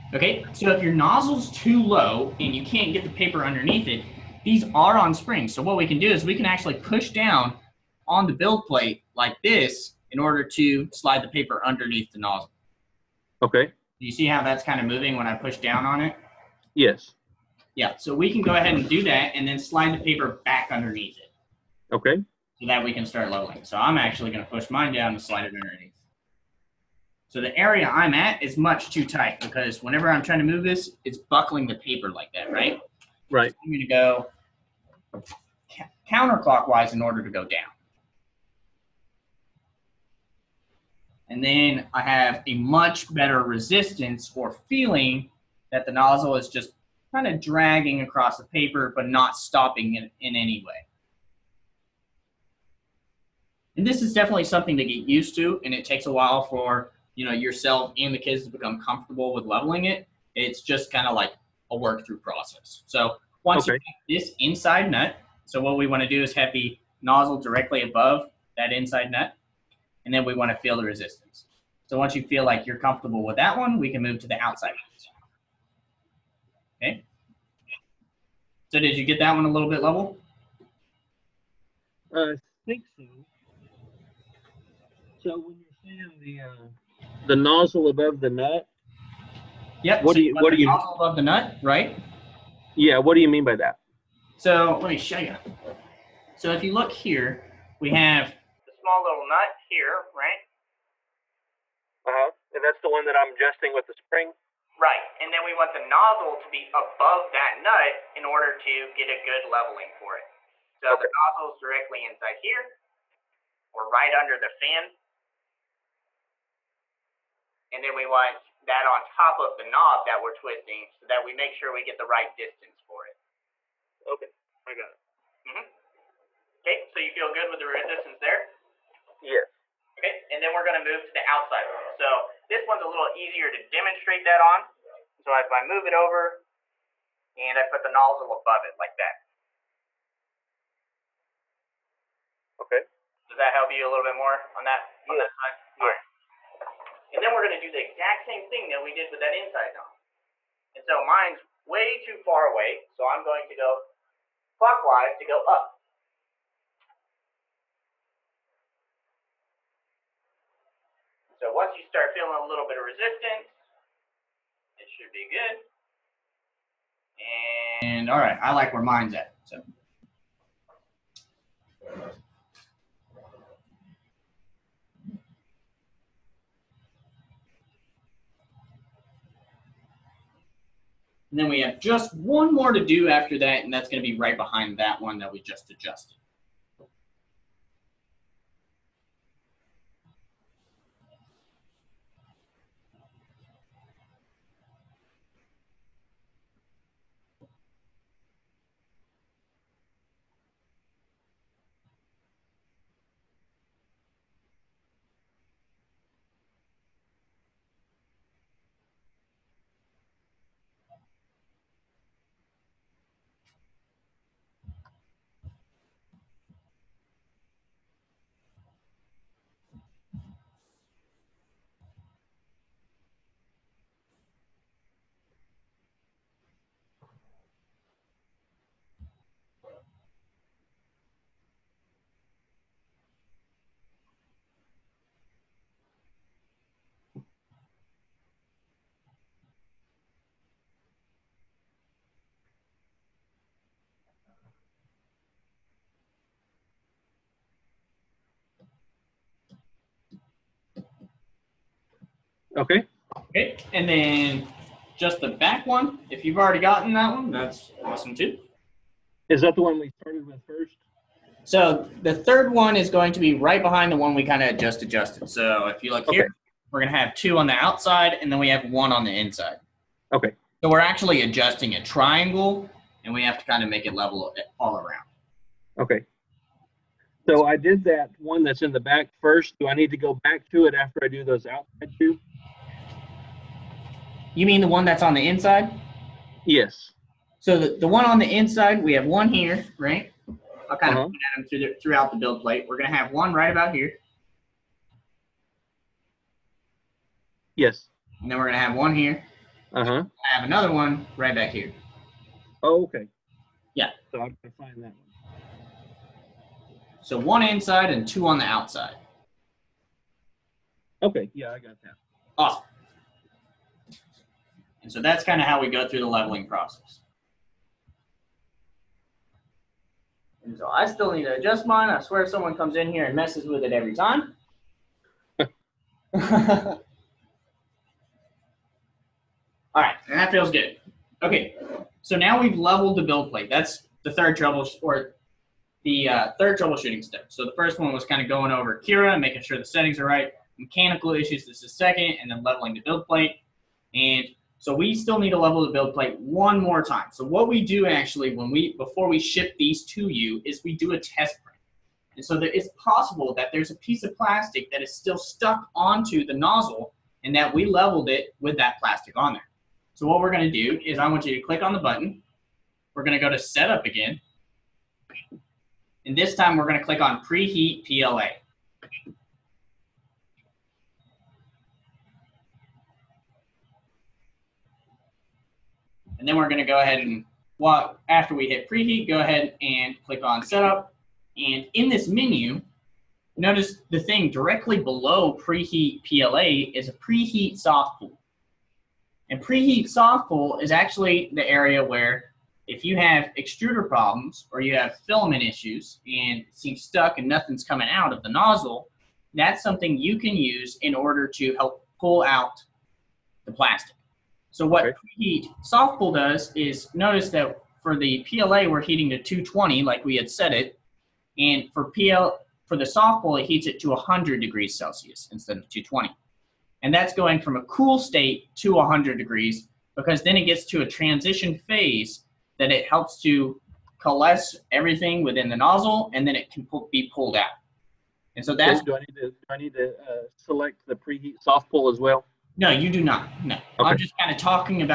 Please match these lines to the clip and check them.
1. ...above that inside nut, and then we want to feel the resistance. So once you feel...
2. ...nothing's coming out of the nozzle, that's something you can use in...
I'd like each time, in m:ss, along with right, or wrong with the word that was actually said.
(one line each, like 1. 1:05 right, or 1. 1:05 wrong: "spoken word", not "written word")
1. 1:07 right
2. 6:37 right.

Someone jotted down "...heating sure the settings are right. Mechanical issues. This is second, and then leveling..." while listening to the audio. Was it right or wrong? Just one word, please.
wrong.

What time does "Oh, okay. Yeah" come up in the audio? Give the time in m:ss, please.
5:02.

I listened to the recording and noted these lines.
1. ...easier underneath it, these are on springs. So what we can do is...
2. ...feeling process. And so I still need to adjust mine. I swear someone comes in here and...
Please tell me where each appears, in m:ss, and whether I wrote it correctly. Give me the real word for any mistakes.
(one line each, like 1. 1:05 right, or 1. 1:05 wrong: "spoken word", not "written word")
1. 0:03 wrong: "paper", not "easier"
2. 5:16 wrong: "leveling", not "feeling".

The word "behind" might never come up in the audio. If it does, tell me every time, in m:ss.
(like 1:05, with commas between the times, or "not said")
3:04, 4:23.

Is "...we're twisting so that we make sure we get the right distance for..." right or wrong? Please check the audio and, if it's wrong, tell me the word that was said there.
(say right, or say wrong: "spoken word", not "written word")
right.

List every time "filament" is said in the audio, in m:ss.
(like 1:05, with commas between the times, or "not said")
6:35.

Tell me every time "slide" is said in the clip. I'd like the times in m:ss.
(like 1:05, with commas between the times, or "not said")
0:10, 0:19, 0:25.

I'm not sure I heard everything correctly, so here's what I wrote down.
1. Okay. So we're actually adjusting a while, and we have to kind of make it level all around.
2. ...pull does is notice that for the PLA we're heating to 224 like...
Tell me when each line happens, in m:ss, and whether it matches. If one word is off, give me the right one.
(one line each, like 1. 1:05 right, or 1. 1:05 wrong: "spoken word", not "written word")
1. 4:30 wrong: "triangle", not "while"
2. 6:45 wrong: "220", not "224".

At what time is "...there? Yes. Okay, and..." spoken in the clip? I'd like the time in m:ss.
2:08.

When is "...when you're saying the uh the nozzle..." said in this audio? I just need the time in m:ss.
1:25.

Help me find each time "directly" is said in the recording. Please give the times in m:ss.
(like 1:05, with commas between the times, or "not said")
1:07, 1:51, 6:24.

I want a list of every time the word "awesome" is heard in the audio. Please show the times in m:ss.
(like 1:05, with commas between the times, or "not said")
4:17, 5:12.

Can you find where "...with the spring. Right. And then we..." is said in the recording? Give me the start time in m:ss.
1:43.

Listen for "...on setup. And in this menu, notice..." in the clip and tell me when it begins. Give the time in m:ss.
6:20.